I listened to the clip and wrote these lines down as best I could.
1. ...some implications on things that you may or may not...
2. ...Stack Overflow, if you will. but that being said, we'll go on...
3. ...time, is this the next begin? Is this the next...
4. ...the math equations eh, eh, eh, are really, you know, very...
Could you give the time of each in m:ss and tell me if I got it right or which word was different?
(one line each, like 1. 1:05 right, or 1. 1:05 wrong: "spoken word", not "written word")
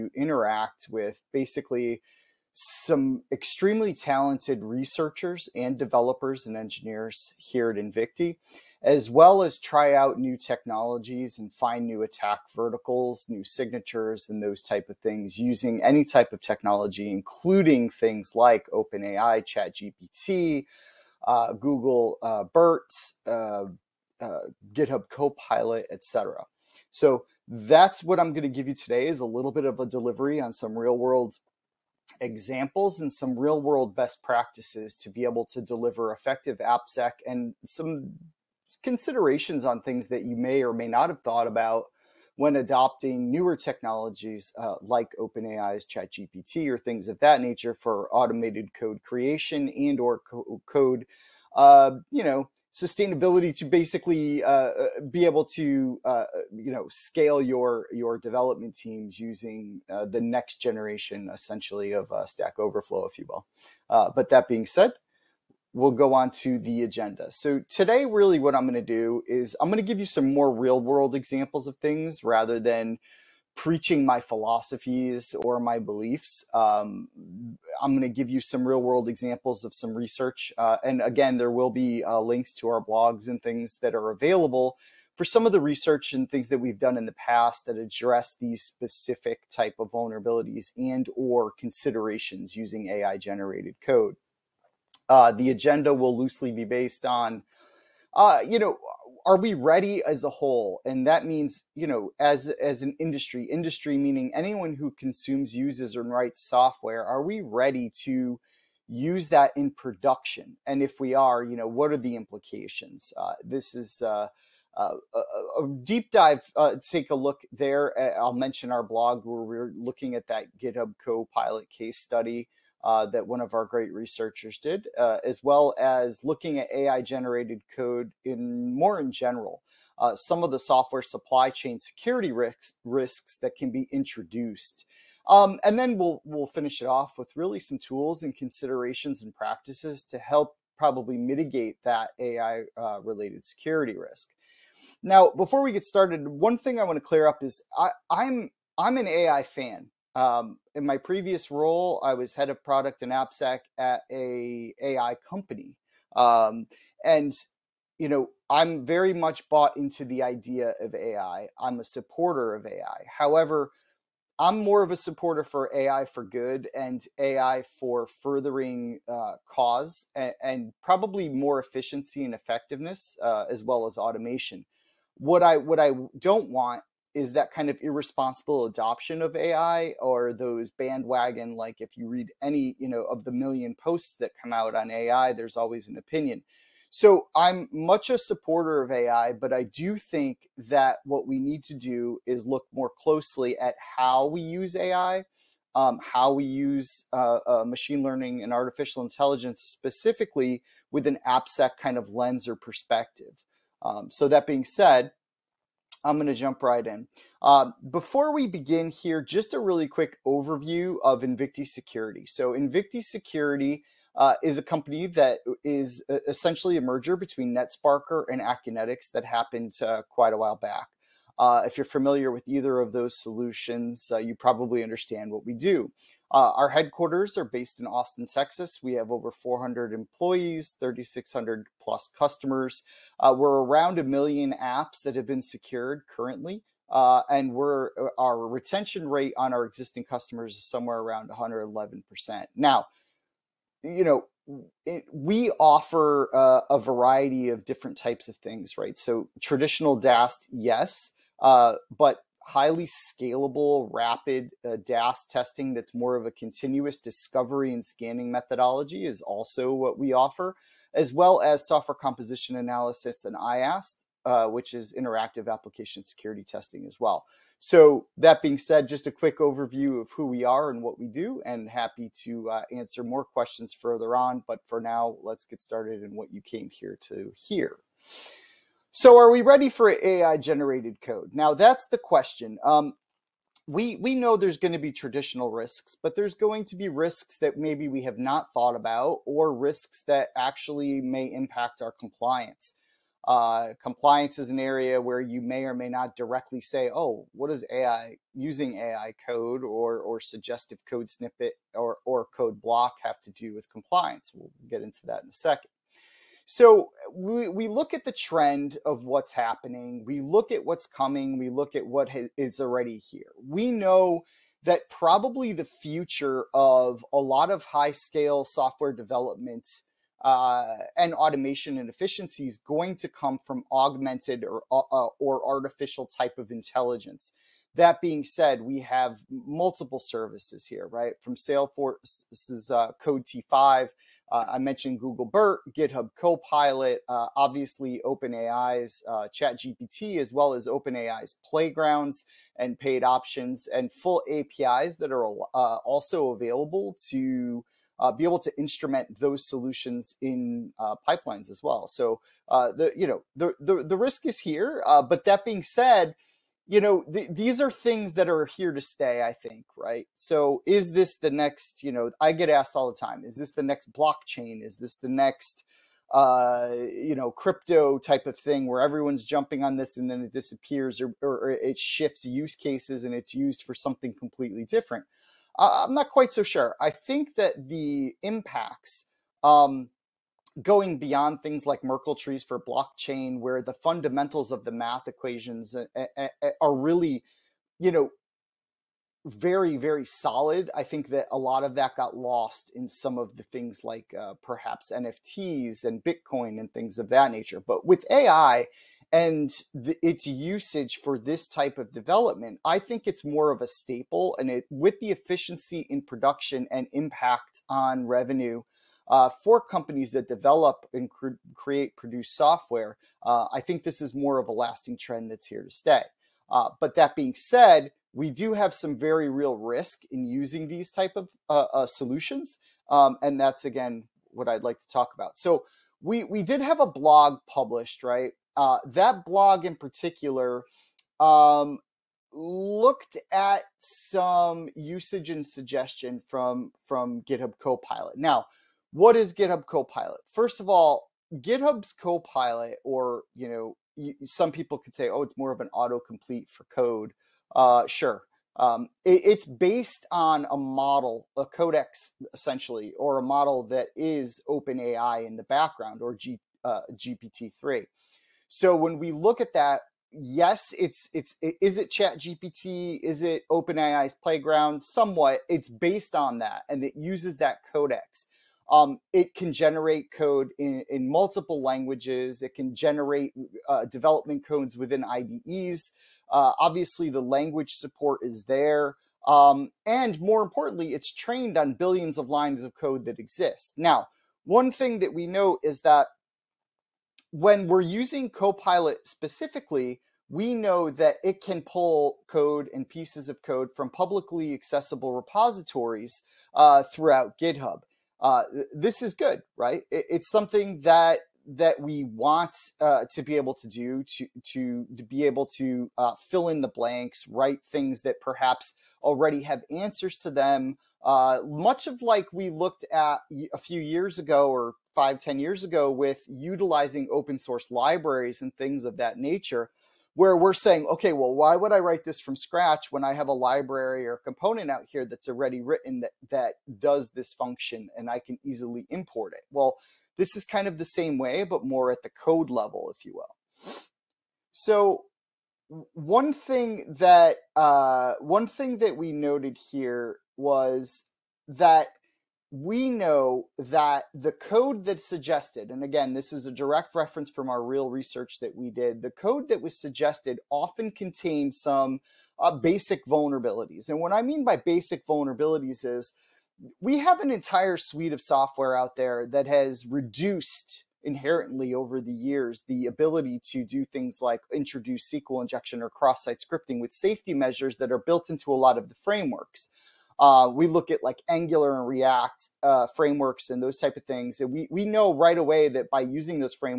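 1. 0:37 wrong: "considerations", not "implications"
2. 1:02 right
3. 6:02 wrong: "blockchain", not "begin"
4. 6:24 right.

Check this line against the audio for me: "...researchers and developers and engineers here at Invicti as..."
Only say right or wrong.
right.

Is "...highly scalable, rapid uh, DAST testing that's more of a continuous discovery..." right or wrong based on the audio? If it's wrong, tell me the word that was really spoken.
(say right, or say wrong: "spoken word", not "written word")
right.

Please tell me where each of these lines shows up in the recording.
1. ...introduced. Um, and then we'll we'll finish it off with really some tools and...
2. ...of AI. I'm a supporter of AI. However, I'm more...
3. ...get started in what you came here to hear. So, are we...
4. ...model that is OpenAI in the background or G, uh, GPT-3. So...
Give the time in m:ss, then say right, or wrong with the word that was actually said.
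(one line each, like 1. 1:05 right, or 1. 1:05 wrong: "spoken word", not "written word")
1. 2:13 right
2. 2:40 right
3. 4:35 right
4. 7:33 right.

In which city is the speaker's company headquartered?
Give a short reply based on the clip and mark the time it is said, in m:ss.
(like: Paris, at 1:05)
Austin, Texas, at 3:47.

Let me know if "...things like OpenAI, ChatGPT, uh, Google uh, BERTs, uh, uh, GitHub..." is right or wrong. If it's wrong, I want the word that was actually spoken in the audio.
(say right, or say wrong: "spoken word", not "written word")
right.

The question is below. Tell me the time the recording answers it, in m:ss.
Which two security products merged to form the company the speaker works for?
3:37.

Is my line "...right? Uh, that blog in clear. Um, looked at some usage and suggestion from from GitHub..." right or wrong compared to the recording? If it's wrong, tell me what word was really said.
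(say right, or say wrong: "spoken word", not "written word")
wrong: "particular", not "clear".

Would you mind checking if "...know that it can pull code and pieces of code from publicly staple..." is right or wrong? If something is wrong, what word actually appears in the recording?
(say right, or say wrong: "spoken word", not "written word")
wrong: "accessible", not "staple".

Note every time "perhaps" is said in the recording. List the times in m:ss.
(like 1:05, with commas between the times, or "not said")
6:34, 8:28.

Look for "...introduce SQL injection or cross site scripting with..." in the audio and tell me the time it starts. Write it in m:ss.
9:24.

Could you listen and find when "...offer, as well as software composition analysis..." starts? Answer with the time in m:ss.
4:20.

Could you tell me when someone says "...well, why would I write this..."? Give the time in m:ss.
8:41.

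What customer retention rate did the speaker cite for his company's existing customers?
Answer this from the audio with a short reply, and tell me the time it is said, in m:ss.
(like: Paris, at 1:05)
111%, at 4:01.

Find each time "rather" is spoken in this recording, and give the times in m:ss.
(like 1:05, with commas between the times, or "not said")
1:12.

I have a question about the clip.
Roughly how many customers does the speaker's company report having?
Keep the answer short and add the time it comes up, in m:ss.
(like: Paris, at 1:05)
3,600 plus, at 3:50.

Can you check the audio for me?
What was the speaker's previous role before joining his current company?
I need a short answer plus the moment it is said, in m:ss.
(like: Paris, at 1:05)
head of product and AppSec, at 2:32.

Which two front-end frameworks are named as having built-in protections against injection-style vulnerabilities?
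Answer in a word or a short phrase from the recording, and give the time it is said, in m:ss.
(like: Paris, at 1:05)
Angular and React, at 9:31.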